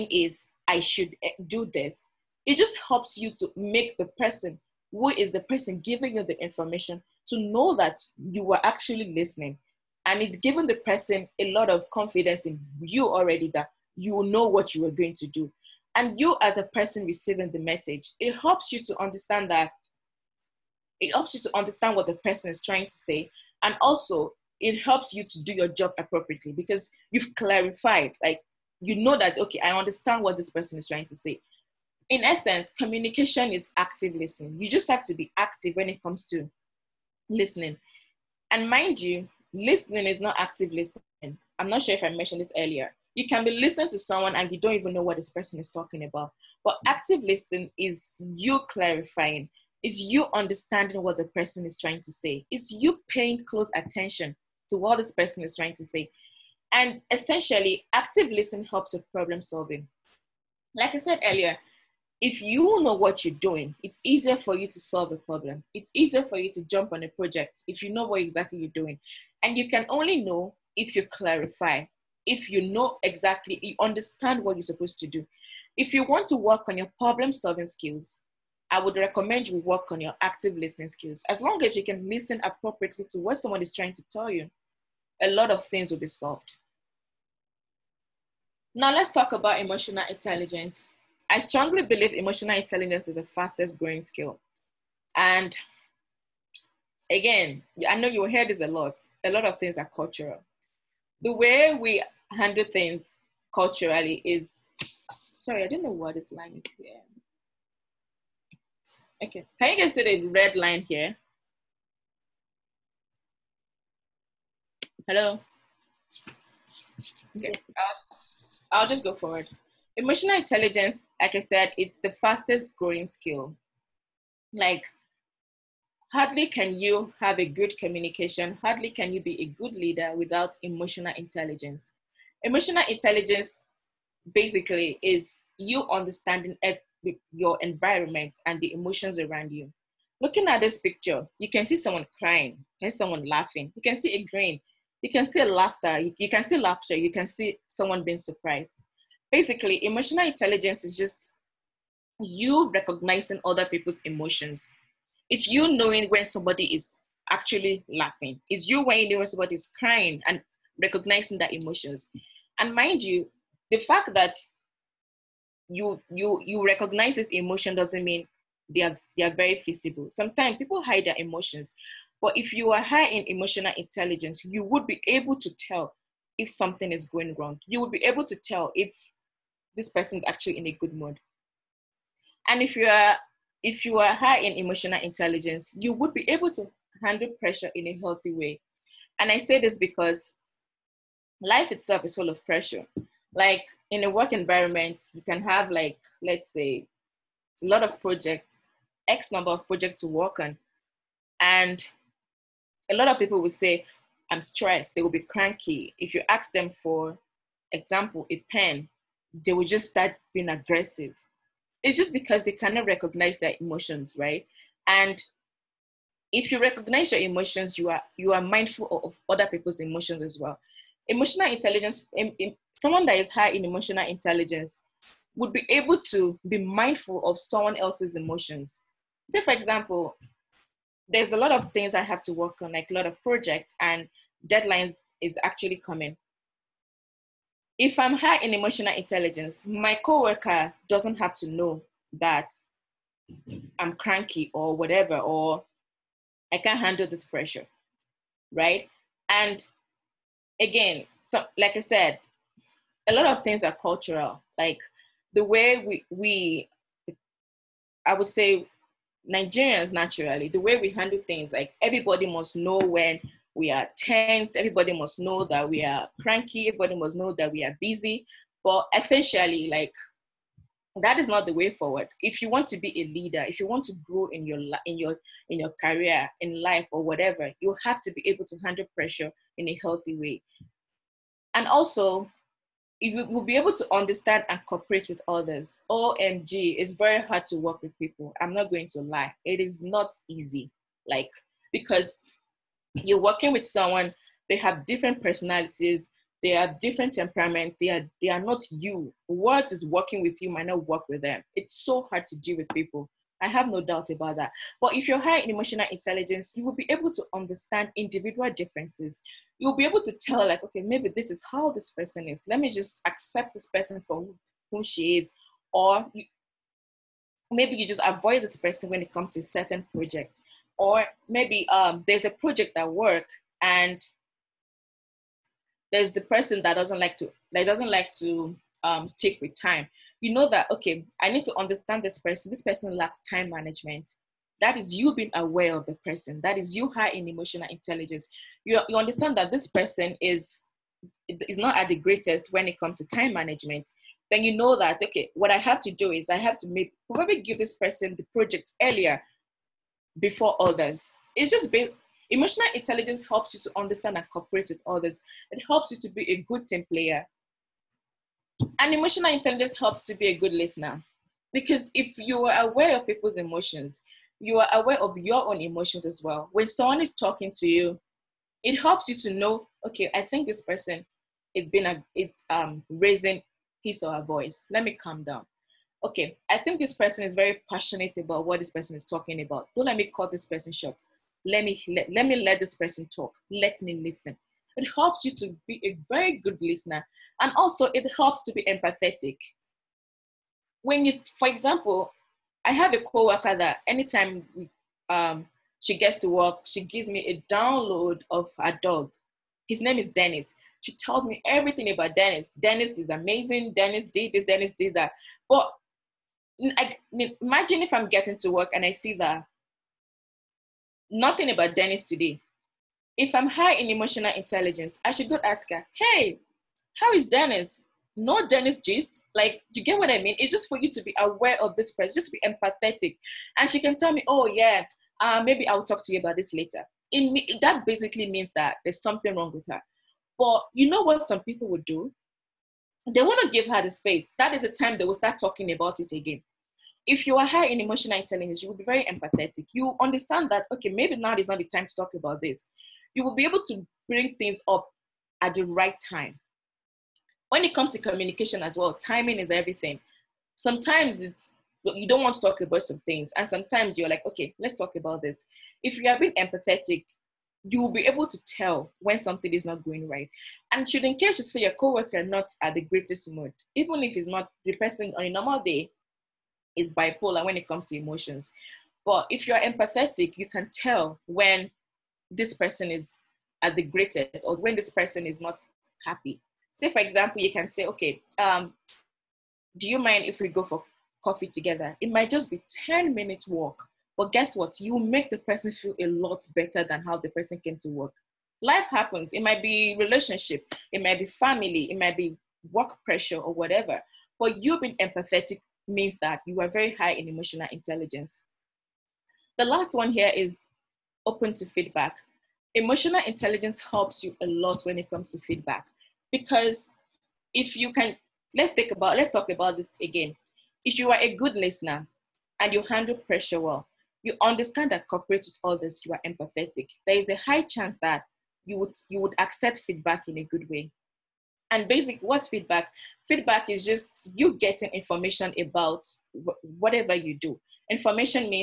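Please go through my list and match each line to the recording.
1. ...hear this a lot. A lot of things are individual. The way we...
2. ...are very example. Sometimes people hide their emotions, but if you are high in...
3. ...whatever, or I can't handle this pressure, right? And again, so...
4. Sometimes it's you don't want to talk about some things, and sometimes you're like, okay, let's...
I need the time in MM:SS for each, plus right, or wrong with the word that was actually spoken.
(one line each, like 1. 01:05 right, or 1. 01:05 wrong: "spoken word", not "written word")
1. 01:38 wrong: "cultural", not "individual"
2. 02:49 wrong: "feasible", not "example"
3. 04:04 right
4. 07:30 right.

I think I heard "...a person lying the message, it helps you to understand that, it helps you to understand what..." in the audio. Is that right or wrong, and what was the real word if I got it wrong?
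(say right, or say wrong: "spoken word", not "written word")
wrong: "receiving", not "lying".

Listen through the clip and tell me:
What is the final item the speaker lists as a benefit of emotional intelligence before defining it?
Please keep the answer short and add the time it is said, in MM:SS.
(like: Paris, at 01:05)
Open to feedback, at 08:21.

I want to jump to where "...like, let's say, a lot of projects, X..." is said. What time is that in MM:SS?
03:15.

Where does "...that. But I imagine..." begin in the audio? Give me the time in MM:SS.
06:44.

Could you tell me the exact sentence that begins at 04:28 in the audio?
But essentially, like that is not the way forward.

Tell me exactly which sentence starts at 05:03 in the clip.
I have no doubt about that.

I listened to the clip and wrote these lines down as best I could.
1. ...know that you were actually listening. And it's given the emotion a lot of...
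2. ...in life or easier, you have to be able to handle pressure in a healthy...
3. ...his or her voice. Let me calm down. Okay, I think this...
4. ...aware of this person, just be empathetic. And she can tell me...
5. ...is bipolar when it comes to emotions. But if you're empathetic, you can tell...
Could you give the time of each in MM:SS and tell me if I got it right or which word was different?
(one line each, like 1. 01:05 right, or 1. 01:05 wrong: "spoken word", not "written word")
1. 00:07 wrong: "person", not "emotion"
2. 04:36 wrong: "whatever", not "easier"
3. 06:13 right
4. 07:01 right
5. 07:46 right.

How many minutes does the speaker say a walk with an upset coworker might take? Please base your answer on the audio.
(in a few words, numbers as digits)
10.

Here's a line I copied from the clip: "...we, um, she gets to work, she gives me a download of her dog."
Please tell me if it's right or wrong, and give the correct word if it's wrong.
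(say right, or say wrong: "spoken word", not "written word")
right.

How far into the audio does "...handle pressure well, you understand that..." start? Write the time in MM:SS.
08:32.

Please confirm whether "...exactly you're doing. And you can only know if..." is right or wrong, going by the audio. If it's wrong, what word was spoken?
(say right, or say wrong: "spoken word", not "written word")
right.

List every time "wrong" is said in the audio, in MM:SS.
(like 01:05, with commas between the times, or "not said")
02:57, 07:09.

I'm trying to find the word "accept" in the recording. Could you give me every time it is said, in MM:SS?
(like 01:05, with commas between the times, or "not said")
05:13, 08:39.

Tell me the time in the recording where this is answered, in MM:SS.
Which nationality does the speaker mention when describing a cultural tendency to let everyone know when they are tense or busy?
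04:19.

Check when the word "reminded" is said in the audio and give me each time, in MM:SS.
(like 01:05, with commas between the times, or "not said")
not said.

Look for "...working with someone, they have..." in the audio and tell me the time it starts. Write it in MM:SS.
04:53.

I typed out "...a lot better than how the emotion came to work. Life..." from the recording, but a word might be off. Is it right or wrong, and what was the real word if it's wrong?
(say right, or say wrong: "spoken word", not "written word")
wrong: "person", not "emotion".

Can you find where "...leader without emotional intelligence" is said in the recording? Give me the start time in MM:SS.
02:09.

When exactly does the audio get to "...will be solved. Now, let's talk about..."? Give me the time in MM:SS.
01:25.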